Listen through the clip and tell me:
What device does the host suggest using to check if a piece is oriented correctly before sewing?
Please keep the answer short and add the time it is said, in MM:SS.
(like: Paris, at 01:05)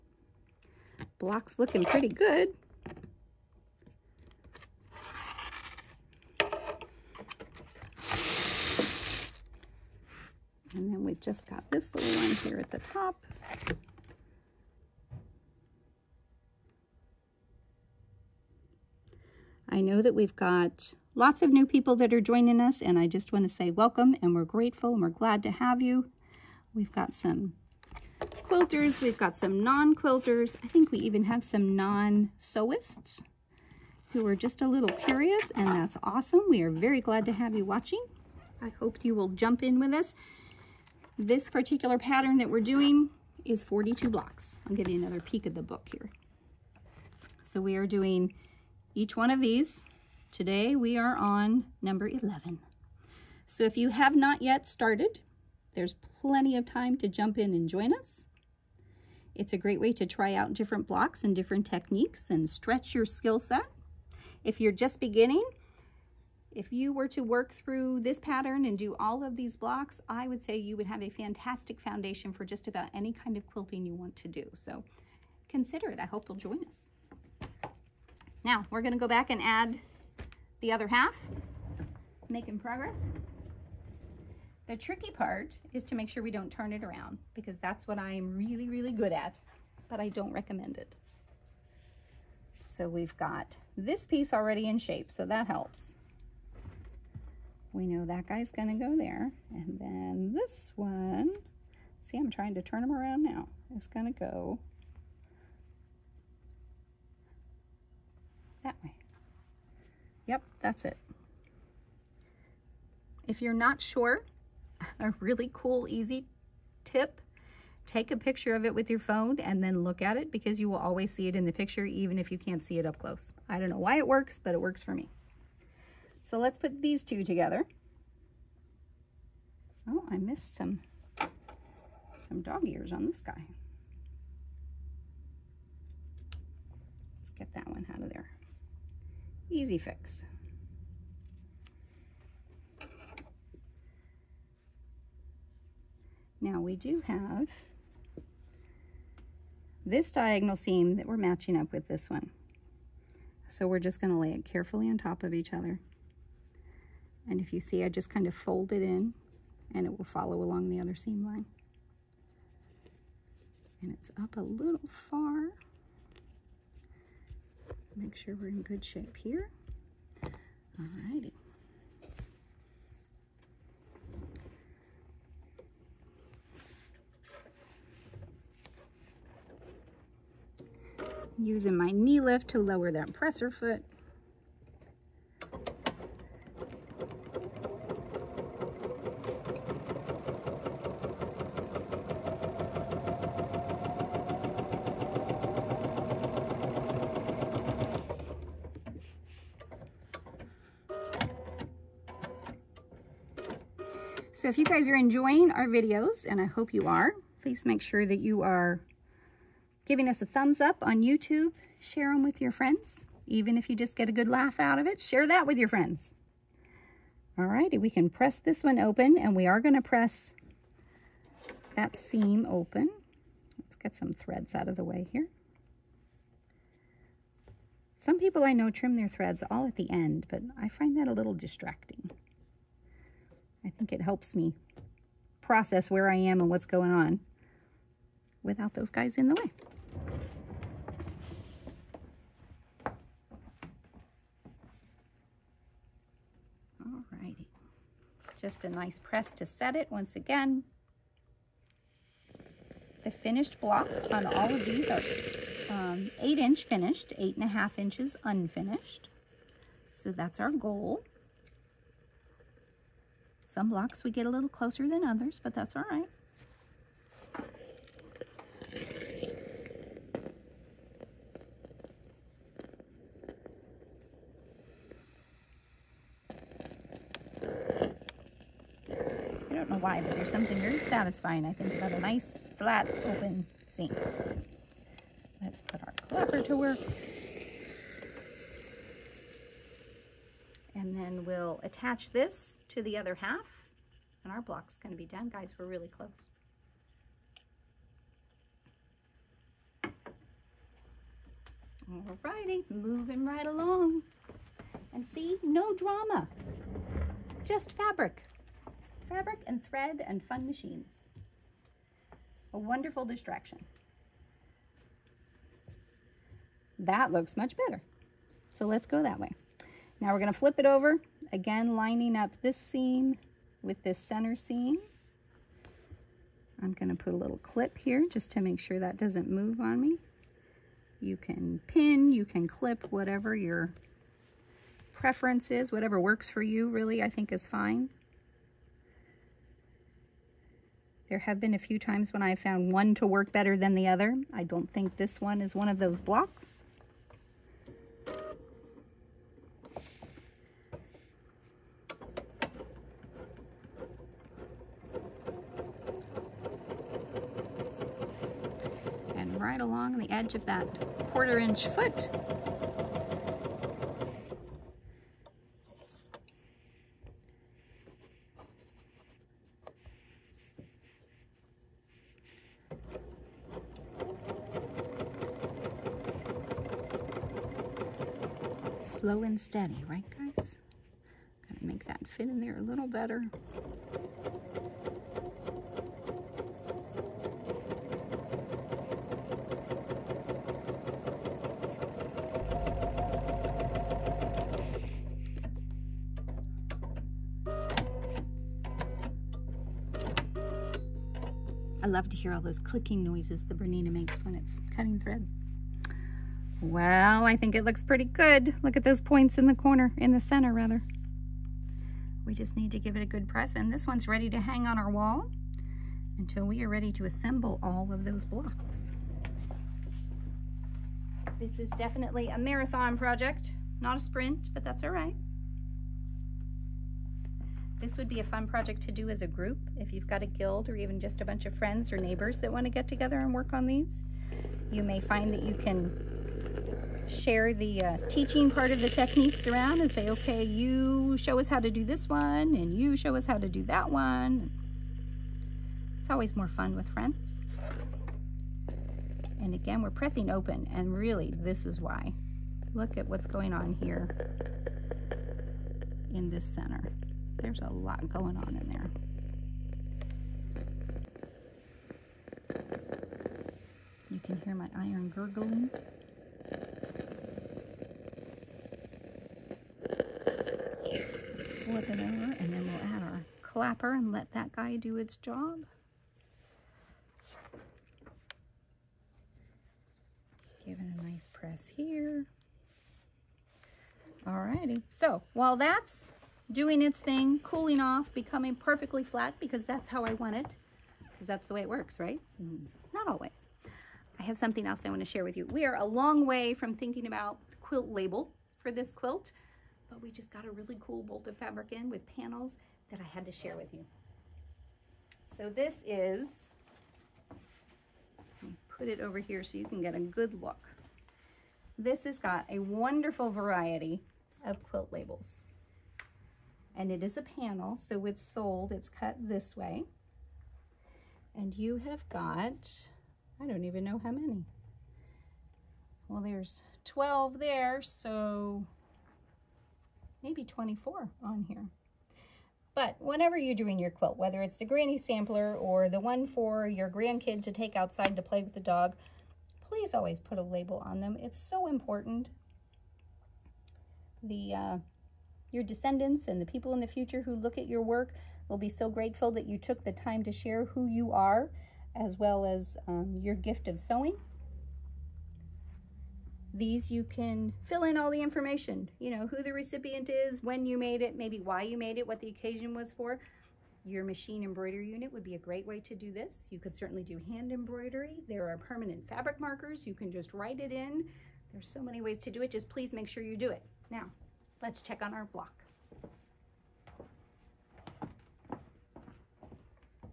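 Your phone, at 01:58.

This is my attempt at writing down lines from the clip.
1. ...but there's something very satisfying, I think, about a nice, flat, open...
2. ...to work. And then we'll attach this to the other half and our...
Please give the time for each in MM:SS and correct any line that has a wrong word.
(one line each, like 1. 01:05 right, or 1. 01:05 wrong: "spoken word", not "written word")
1. 04:40 right
2. 04:46 right.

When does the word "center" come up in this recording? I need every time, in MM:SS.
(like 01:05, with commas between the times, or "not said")
05:23, 06:50, 07:36.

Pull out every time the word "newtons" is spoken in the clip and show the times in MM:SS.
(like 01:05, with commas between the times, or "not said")
not said.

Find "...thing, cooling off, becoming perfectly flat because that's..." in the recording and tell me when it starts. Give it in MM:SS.
08:06.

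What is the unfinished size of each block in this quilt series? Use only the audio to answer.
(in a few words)
8.5 inches.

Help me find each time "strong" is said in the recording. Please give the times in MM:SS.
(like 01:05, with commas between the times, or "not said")
not said.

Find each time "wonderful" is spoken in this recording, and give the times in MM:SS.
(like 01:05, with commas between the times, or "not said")
05:12, 08:32.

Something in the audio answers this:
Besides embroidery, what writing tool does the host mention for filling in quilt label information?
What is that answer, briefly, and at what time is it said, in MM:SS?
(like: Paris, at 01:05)
Permanent fabric markers, at 09:28.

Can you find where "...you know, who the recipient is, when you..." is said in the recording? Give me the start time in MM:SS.
09:18.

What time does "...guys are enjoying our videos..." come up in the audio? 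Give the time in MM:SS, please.
03:24.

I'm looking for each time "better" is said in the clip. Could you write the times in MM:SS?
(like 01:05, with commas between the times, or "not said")
05:17, 05:43, 06:22.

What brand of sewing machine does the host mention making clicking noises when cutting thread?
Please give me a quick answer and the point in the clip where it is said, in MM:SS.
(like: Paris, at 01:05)
Bernina, at 06:43.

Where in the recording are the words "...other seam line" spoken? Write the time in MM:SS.
02:40.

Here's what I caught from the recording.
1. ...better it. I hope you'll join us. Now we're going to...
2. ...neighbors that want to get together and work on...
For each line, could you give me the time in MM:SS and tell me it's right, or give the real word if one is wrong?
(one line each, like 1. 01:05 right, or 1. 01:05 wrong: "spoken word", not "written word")
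1. 01:15 wrong: "consider", not "better"
2. 07:11 right.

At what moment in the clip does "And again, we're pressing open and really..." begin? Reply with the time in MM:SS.
07:29.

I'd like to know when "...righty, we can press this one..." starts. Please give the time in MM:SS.
03:37.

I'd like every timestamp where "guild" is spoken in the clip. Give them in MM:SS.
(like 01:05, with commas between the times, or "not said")
07:10.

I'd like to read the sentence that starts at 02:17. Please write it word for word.
Let's get that one out of there.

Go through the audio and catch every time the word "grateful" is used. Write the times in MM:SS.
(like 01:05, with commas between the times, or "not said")
00:24, 09:08.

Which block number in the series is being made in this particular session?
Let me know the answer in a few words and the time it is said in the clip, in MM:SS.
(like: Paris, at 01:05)
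11, at 00:51.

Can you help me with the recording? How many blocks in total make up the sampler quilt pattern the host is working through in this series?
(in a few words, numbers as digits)
42.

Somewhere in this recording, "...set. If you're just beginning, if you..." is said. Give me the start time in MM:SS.
01:03.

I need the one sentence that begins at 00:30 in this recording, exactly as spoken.
I think we even have some non-sewists who are just a little curious, and that's awesome.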